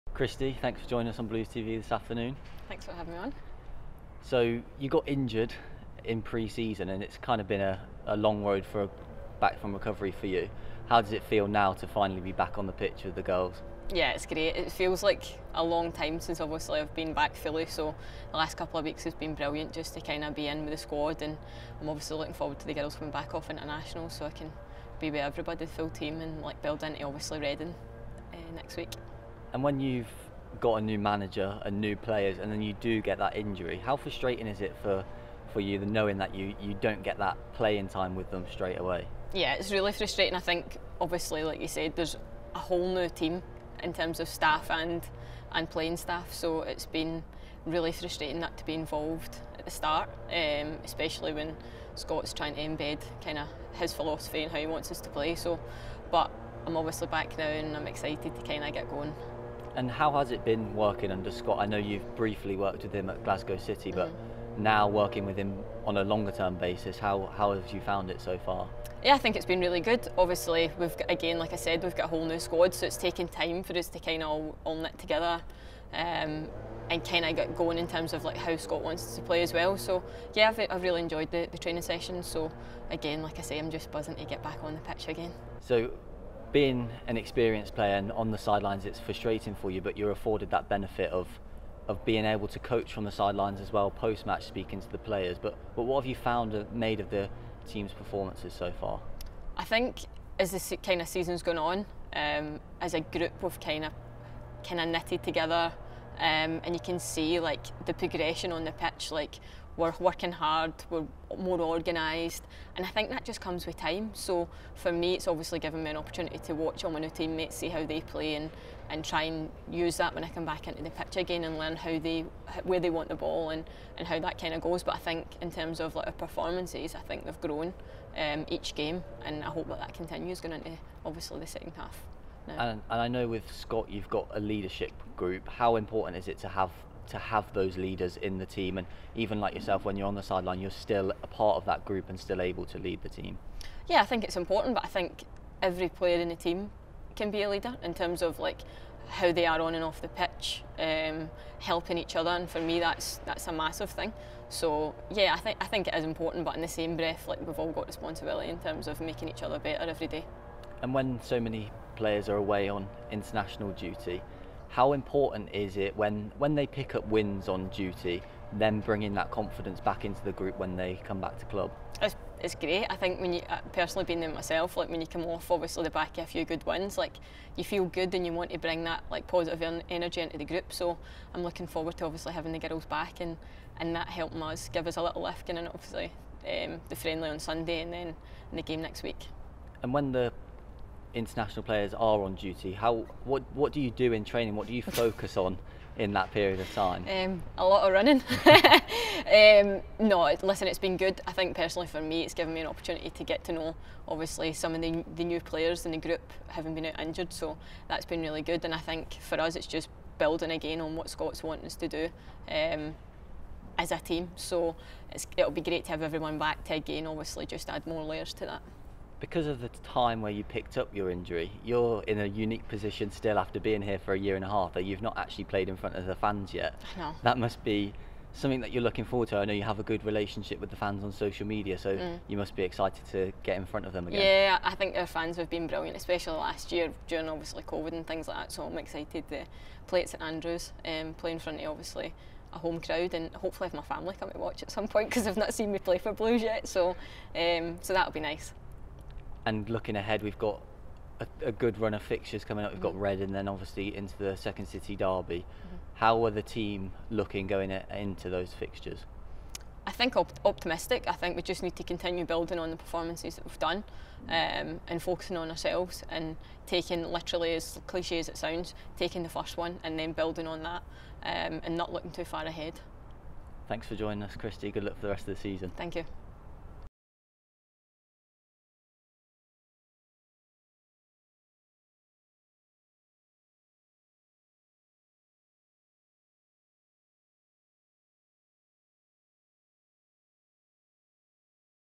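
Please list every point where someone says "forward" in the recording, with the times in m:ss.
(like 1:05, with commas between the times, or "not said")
0:22, 3:01, 3:49.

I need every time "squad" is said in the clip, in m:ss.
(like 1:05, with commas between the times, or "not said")
0:20, 1:12.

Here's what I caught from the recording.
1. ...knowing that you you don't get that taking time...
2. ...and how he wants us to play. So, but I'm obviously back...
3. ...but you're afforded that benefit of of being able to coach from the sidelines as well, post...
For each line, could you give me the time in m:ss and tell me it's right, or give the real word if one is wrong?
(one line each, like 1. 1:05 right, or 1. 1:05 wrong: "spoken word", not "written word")
1. 0:35 wrong: "playing", not "taking"
2. 0:54 right
3. 1:29 right.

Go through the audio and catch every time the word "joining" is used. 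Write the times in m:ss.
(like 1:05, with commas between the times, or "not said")
0:00, 4:33.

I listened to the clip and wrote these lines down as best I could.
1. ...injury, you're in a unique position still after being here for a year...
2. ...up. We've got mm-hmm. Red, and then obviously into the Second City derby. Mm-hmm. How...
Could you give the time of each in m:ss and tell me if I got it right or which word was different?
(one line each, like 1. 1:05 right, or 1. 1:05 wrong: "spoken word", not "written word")
1. 3:41 right
2. 4:12 right.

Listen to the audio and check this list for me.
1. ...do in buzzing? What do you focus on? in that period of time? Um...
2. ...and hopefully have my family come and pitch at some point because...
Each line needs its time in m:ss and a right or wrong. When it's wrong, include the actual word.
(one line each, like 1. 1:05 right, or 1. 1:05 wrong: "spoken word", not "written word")
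1. 3:13 wrong: "training", not "buzzing"
2. 4:03 wrong: "watch", not "pitch".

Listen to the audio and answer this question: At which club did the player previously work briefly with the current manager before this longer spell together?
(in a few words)
Glasgow City.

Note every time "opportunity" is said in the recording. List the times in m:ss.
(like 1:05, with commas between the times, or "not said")
1:55, 3:22.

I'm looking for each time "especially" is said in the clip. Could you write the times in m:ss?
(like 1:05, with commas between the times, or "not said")
0:50, 3:55.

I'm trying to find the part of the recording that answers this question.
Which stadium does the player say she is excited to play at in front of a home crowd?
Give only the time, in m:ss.
4:00.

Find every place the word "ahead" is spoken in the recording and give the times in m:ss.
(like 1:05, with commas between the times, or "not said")
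4:09, 4:32.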